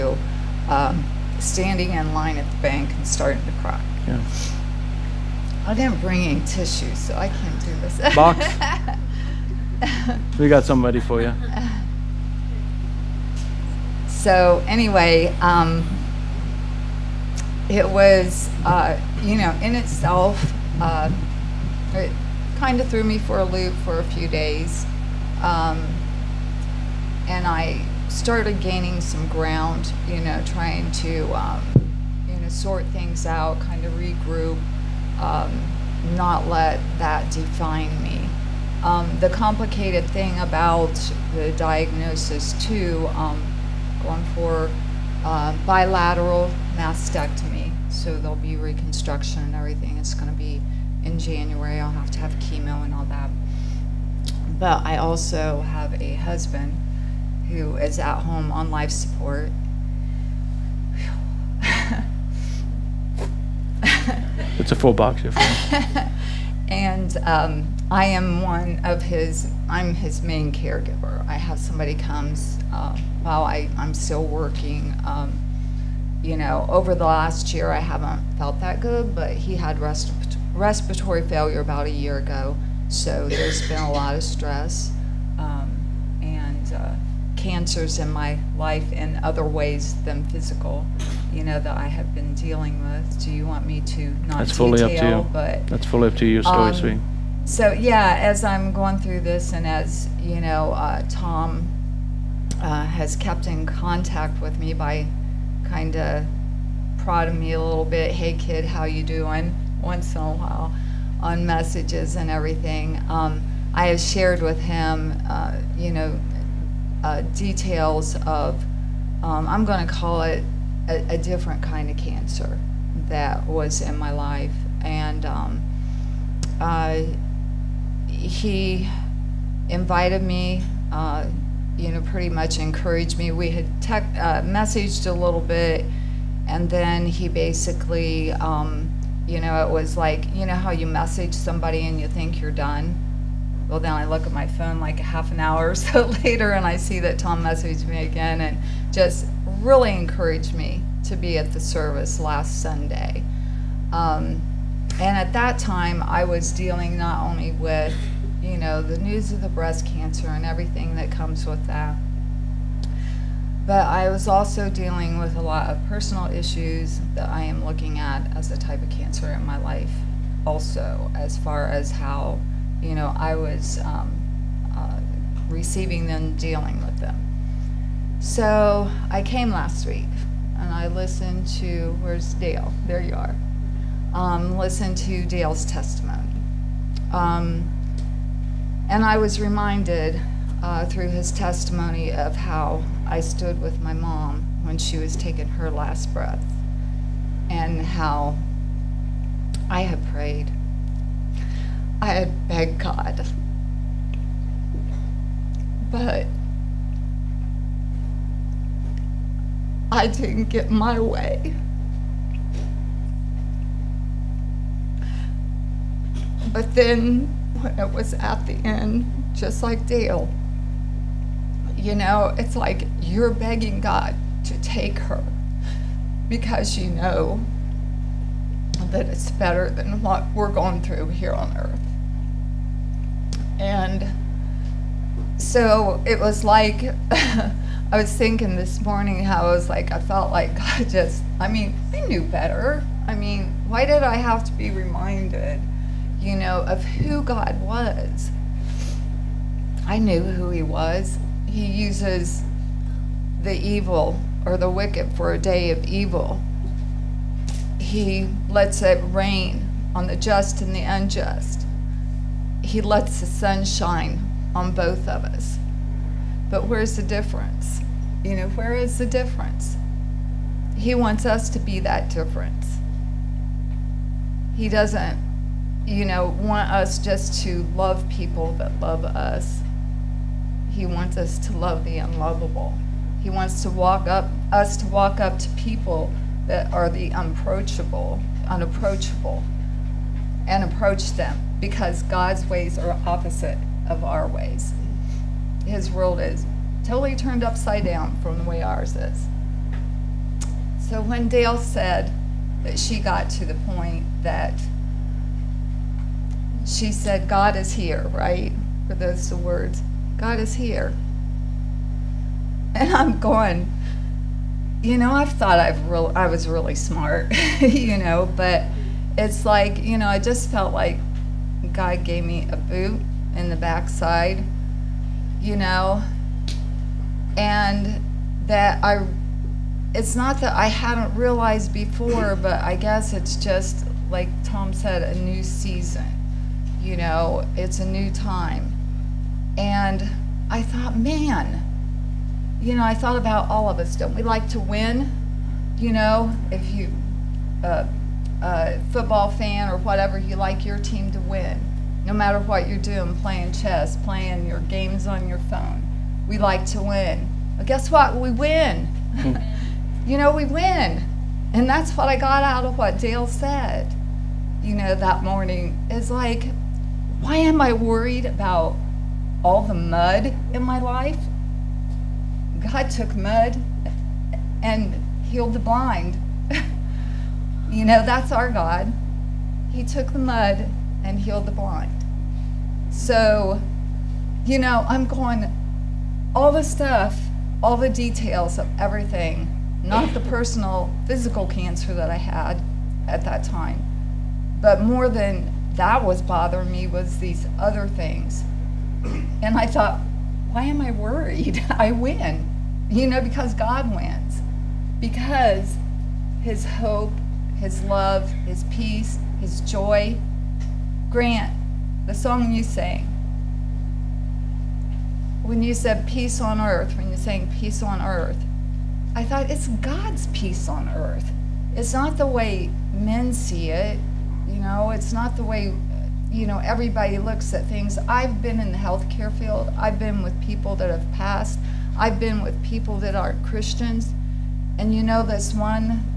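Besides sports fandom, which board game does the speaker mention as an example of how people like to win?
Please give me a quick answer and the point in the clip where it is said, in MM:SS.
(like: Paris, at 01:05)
chess, at 05:53.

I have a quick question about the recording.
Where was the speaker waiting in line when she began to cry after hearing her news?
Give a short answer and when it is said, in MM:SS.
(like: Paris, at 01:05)
the bank, at 00:02.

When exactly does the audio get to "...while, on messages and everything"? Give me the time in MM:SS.
01:50.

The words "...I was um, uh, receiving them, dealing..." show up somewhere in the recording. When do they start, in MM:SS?
02:53.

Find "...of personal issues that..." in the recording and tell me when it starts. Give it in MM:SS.
02:45.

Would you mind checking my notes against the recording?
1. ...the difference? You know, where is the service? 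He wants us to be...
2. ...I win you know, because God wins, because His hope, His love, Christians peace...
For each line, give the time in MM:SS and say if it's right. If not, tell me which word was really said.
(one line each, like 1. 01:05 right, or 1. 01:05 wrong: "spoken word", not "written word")
1. 04:26 wrong: "difference", not "service"
2. 06:41 wrong: "His", not "Christians".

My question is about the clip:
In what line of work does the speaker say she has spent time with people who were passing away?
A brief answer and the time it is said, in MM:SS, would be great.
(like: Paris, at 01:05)
the healthcare field, at 07:08.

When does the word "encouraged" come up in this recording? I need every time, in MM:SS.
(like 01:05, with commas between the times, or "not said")
02:12, 02:29.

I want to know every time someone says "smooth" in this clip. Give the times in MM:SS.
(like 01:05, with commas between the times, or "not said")
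not said.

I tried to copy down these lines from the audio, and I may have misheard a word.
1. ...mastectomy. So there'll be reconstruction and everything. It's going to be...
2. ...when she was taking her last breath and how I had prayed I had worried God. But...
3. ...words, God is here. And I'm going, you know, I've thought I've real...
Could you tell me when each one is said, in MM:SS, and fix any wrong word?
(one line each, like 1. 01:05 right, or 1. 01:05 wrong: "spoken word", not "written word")
1. 00:46 right
2. 03:14 wrong: "begged", not "worried"
3. 05:09 right.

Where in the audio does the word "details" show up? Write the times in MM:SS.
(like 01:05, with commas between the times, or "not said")
01:34, 01:57, 06:27.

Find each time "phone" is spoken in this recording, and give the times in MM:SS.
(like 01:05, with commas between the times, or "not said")
02:24, 05:55.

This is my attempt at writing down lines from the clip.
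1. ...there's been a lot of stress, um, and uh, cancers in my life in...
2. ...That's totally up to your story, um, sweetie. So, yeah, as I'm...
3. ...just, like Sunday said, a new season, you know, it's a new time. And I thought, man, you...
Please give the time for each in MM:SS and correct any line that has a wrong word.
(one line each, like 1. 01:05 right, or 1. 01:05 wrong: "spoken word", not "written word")
1. 01:23 right
2. 01:35 wrong: "fully", not "totally"
3. 05:33 wrong: "Tom", not "Sunday".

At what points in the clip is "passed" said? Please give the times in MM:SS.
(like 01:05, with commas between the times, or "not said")
07:11.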